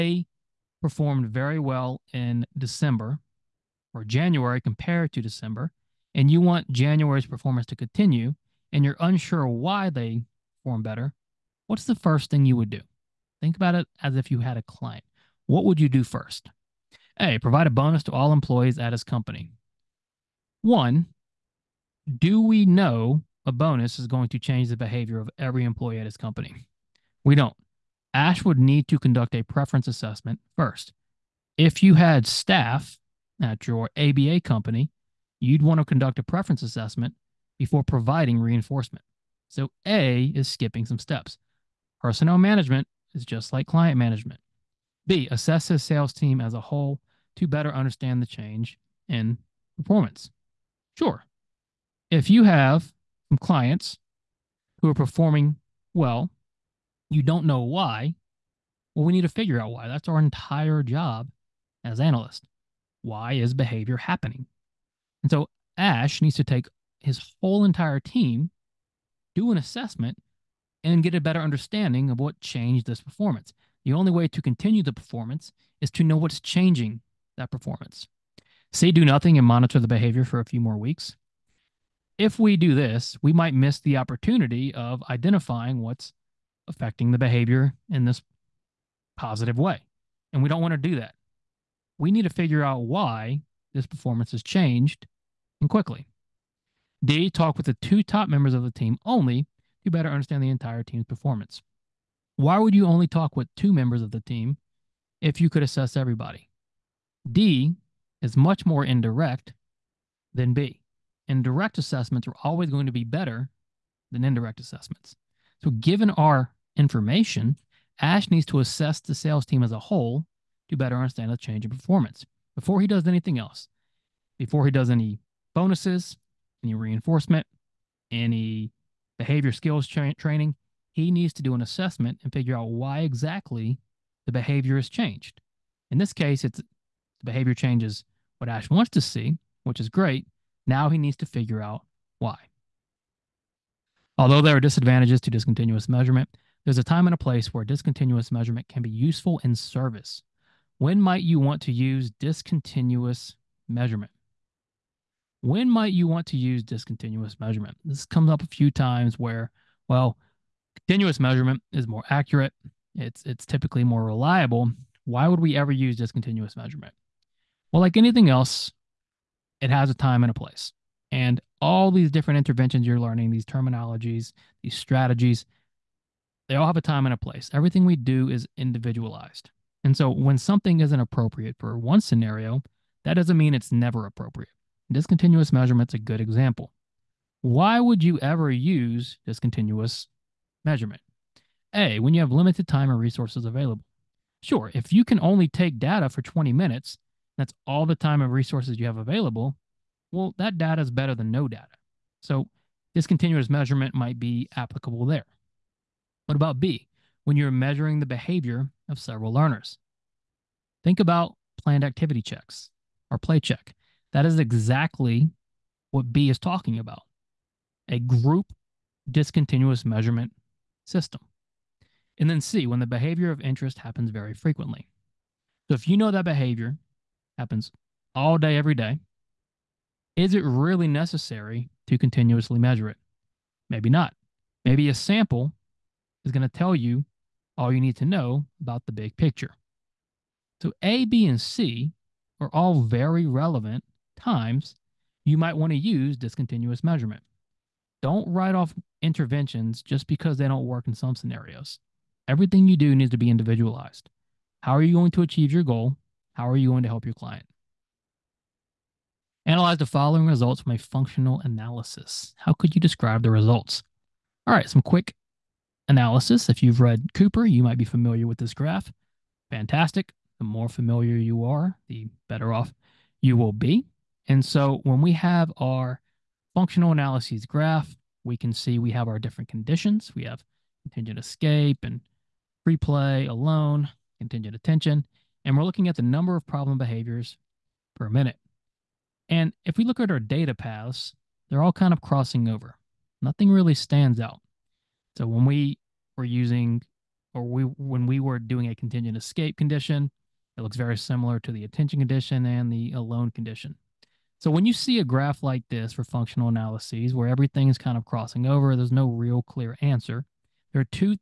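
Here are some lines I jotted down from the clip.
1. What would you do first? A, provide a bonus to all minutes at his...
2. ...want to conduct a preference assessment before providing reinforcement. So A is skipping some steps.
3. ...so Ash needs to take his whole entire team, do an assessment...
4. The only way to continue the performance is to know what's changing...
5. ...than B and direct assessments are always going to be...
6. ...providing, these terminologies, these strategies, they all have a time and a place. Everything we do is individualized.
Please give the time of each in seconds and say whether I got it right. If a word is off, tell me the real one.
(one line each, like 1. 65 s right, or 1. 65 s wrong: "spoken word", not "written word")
1. 15 s wrong: "employees", not "minutes"
2. 35 s right
3. 65 s right
4. 73 s right
5. 110 s right
6. 172 s wrong: "learning", not "providing".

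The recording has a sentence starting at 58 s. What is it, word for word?
Well, we need to figure out why.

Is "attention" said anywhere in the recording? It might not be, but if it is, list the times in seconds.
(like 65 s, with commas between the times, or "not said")
284 s, 301 s.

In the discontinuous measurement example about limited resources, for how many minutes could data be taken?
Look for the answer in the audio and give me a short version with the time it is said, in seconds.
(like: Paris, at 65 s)
20 minutes, at 196 s.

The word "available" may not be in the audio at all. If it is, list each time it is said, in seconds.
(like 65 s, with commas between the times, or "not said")
193 s, 198 s.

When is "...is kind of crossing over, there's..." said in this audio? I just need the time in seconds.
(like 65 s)
307 s.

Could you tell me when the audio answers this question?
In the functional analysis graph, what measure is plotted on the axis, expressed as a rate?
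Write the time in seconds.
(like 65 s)
286 s.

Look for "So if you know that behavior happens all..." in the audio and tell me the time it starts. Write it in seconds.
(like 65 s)
225 s.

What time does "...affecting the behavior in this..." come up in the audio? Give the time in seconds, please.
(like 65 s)
86 s.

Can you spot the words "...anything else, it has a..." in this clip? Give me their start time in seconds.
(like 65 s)
167 s.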